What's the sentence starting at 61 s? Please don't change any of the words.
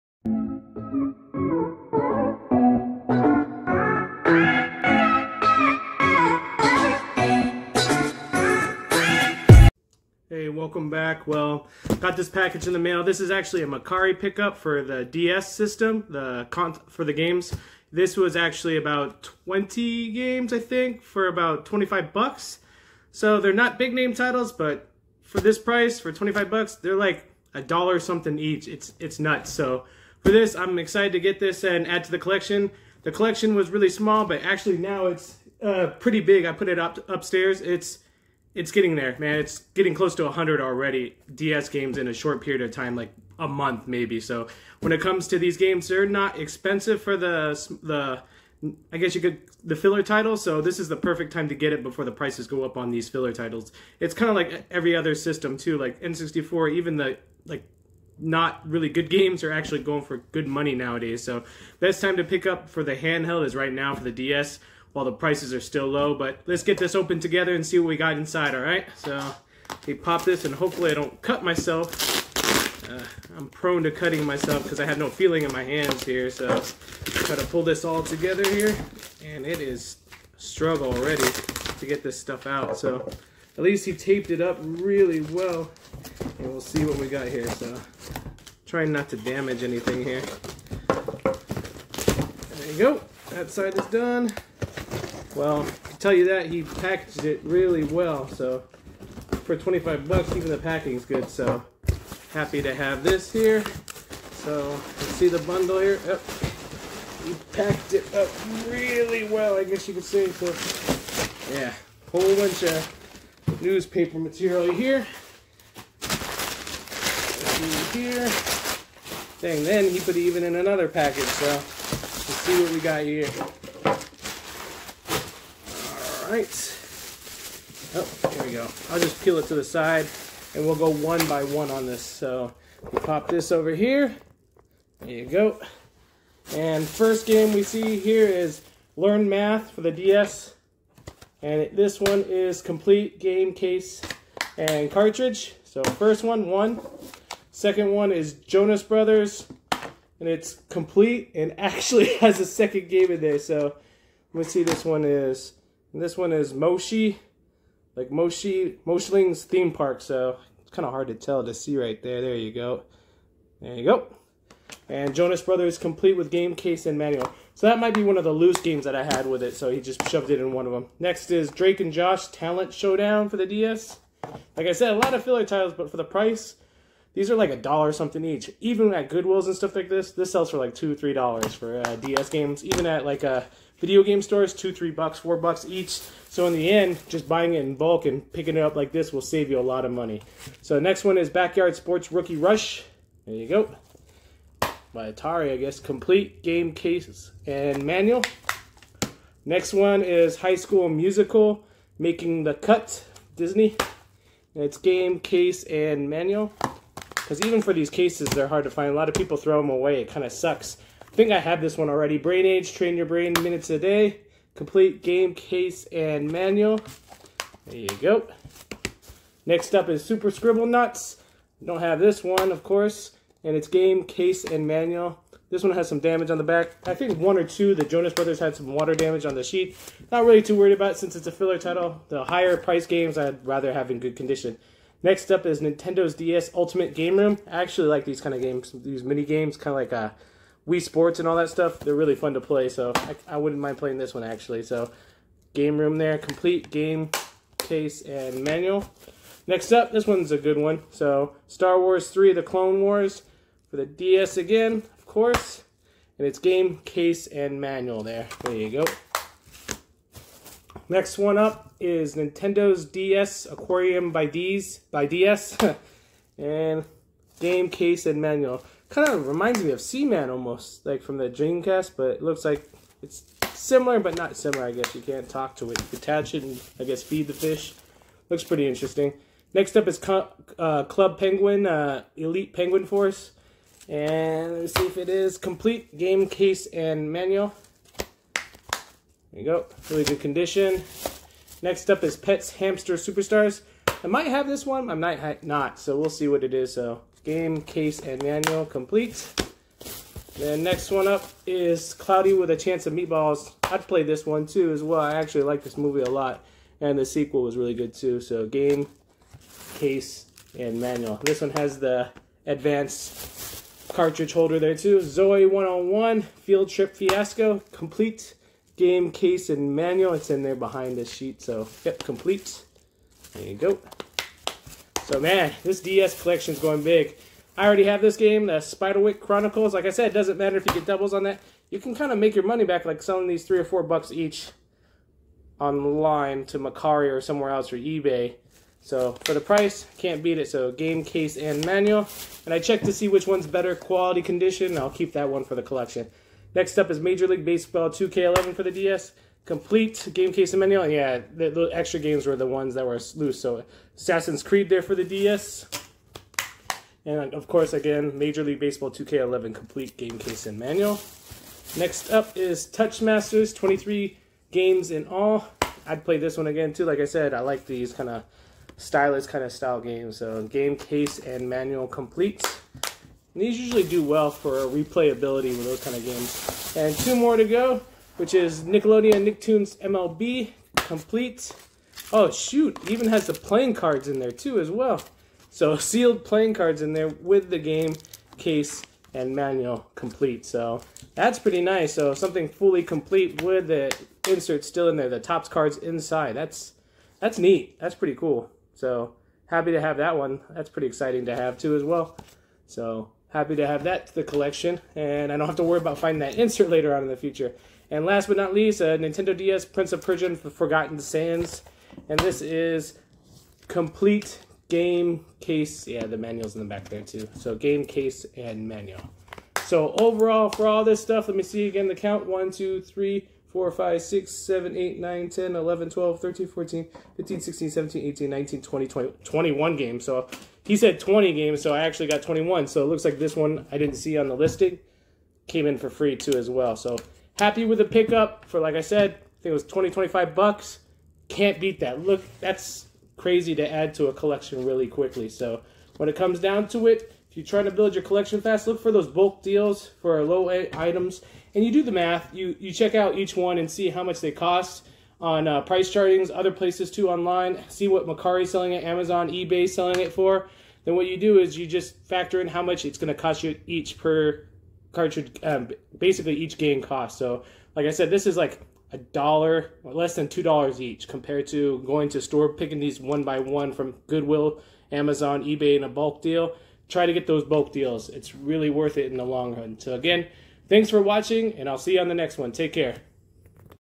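So best time to pick up for the handheld is right now for the DS while the prices are still low.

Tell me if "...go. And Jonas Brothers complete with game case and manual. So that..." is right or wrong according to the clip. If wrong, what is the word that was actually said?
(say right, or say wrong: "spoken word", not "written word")
right.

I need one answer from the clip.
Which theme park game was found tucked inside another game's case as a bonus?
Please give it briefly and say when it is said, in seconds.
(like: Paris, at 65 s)
Moshling's theme park, at 158 s.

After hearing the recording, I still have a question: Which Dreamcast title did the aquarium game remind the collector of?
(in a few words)
Seaman.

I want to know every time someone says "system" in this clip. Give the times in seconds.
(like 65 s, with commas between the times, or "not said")
15 s, 55 s.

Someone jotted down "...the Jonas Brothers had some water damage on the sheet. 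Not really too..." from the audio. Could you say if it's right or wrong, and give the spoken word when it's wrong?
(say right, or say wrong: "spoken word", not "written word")
right.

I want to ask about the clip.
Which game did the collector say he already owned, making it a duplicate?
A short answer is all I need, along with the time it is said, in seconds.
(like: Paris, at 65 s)
The Spiderwick Chronicles, at 328 s.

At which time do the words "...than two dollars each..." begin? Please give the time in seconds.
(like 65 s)
470 s.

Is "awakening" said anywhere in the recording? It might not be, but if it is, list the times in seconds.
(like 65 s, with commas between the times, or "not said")
not said.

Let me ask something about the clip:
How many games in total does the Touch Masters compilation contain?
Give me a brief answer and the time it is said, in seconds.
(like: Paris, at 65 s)
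23, at 363 s.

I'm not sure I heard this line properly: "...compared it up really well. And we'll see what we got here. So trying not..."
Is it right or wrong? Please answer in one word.
wrong.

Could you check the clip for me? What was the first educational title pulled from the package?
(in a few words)
Learn Math.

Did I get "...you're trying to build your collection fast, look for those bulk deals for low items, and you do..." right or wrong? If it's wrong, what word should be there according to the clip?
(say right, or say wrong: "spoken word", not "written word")
right.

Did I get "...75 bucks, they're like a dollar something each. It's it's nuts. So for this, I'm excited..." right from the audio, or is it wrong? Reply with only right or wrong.
wrong.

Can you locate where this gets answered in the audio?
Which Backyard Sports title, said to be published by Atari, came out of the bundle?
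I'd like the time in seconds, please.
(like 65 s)
192 s.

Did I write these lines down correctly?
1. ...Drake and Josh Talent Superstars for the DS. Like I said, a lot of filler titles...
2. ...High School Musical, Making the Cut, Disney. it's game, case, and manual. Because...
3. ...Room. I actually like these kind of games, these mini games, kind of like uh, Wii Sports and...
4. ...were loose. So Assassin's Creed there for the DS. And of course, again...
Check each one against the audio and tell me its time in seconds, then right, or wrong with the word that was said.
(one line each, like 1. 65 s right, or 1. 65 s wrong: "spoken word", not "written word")
1. 171 s wrong: "Showdown", not "Superstars"
2. 200 s right
3. 237 s right
4. 352 s right.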